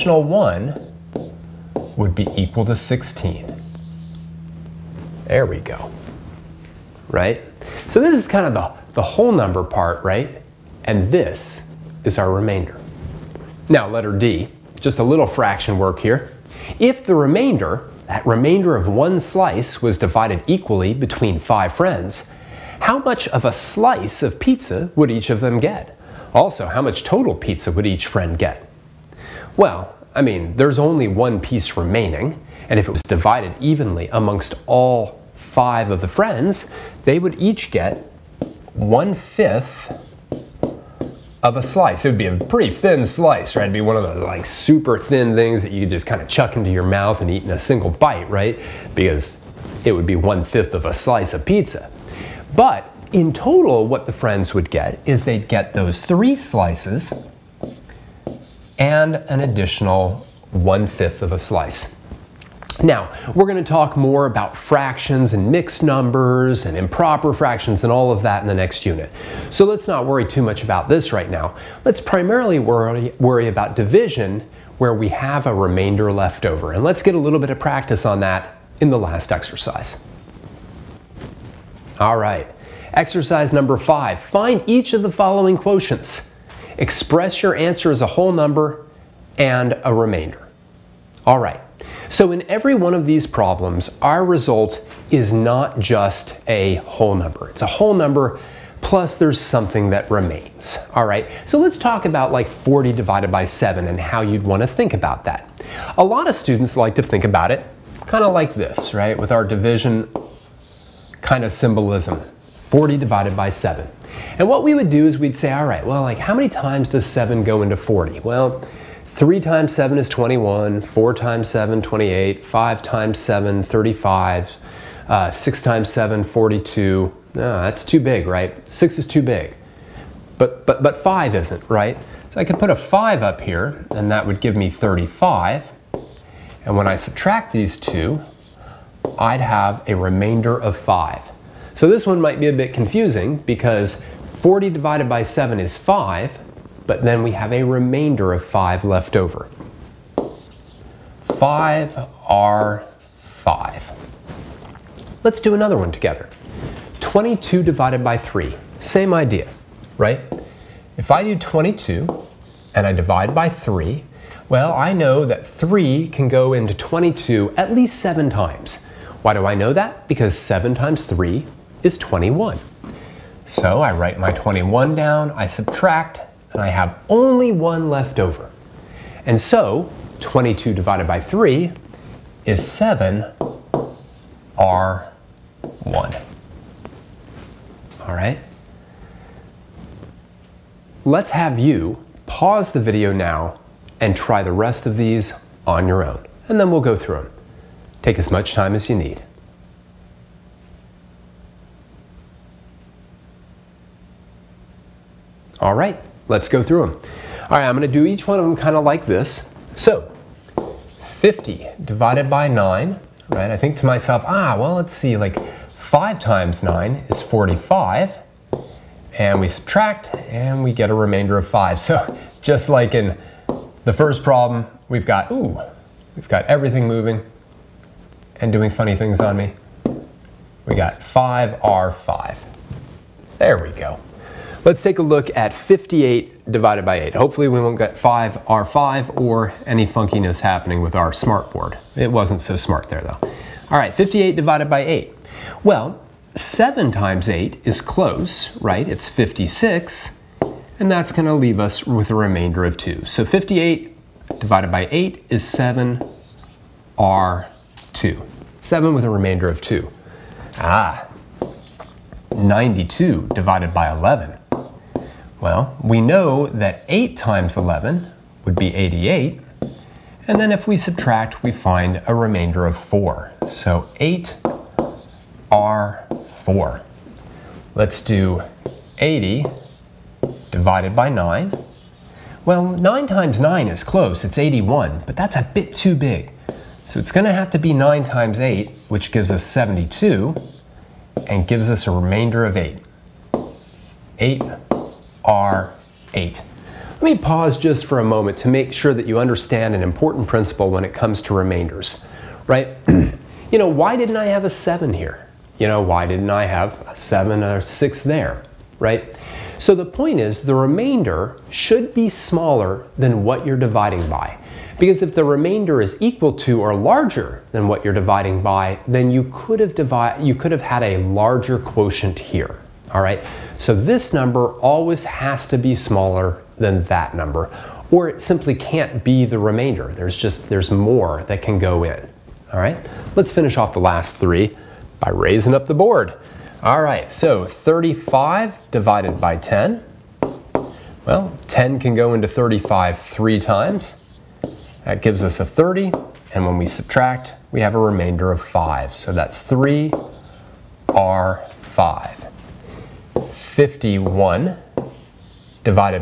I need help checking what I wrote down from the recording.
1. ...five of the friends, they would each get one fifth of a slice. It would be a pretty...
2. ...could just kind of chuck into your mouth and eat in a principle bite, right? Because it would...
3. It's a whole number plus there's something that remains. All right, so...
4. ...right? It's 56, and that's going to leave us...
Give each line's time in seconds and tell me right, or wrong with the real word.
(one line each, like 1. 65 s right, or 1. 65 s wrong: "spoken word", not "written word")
1. 35 s right
2. 45 s wrong: "single", not "principle"
3. 97 s right
4. 248 s right.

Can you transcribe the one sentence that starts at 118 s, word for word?
Well, 3 times 7 is 21, 4 times 7, 28, 5 times 7, 35, uh, 6 times 7, 42.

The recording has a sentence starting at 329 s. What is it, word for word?
There's just, there's more that can go in, all right?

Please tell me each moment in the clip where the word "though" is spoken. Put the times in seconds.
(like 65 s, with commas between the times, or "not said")
243 s.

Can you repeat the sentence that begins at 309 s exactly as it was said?
So the point is the remainder should be smaller than what you're dividing by.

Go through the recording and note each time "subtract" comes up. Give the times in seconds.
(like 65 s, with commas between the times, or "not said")
136 s, 175 s, 219 s, 270 s, 346 s.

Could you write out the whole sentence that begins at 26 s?
Also, how much total pizza would each friend get?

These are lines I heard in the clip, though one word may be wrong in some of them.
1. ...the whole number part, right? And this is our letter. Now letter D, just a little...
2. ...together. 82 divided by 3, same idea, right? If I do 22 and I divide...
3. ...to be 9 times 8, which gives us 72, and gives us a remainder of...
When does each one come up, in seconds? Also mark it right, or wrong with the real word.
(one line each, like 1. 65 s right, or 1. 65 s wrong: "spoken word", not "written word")
1. 8 s wrong: "remainder", not "letter"
2. 155 s wrong: "22", not "82"
3. 287 s right.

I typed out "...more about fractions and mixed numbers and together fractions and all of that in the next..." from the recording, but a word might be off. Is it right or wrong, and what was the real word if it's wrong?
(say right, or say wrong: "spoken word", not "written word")
wrong: "improper", not "together".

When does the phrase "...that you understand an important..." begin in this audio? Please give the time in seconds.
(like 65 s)
298 s.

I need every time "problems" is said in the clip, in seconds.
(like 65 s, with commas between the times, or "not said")
93 s, 224 s.